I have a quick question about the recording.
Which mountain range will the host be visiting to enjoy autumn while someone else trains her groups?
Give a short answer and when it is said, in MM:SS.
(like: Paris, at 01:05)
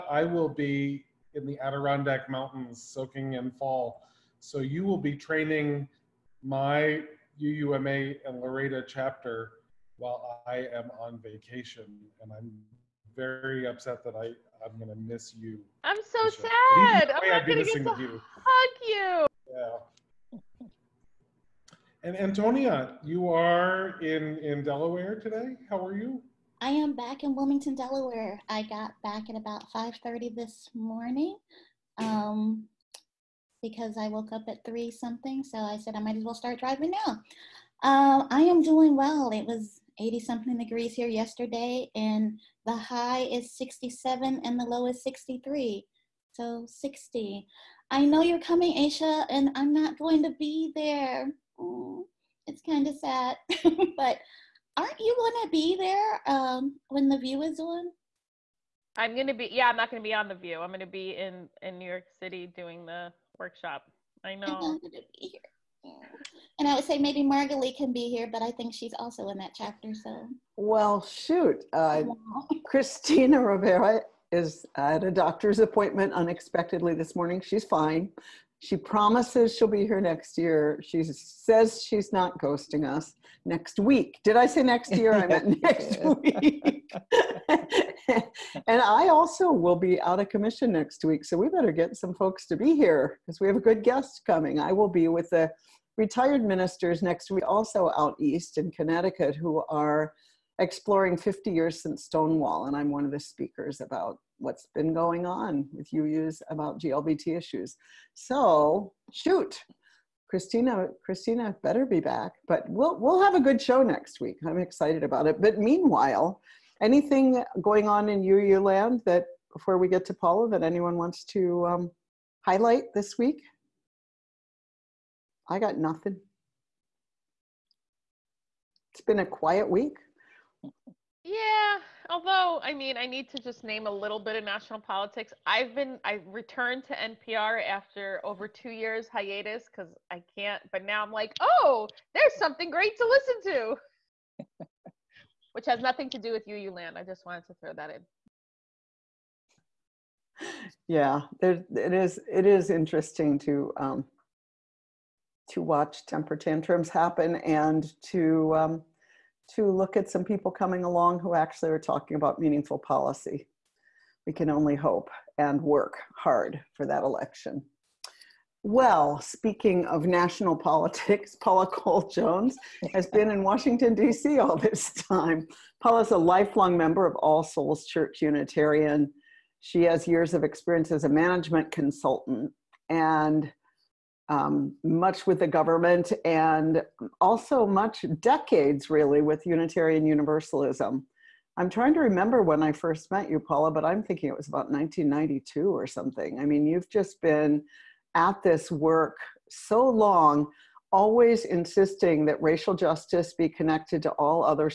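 Adirondack Mountains, at 00:01.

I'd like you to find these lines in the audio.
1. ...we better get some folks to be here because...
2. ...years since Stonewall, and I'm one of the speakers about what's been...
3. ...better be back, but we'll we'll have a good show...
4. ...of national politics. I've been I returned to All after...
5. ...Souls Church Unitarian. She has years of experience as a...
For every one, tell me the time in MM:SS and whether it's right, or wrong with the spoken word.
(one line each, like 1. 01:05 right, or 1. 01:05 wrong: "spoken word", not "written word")
1. 01:31 right
2. 01:41 right
3. 01:51 right
4. 02:14 wrong: "NPR", not "All"
5. 02:57 right.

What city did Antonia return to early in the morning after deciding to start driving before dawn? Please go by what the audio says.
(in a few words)
Wilmington, Delaware.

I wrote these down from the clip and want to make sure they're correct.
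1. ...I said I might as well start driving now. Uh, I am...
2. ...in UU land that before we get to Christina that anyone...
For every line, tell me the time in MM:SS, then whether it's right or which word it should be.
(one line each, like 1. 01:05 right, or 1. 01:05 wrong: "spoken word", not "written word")
1. 00:35 right
2. 01:58 wrong: "Paula", not "Christina".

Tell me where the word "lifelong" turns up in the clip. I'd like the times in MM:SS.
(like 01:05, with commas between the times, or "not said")
02:56.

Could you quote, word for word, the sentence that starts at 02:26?
I just wanted to throw that in.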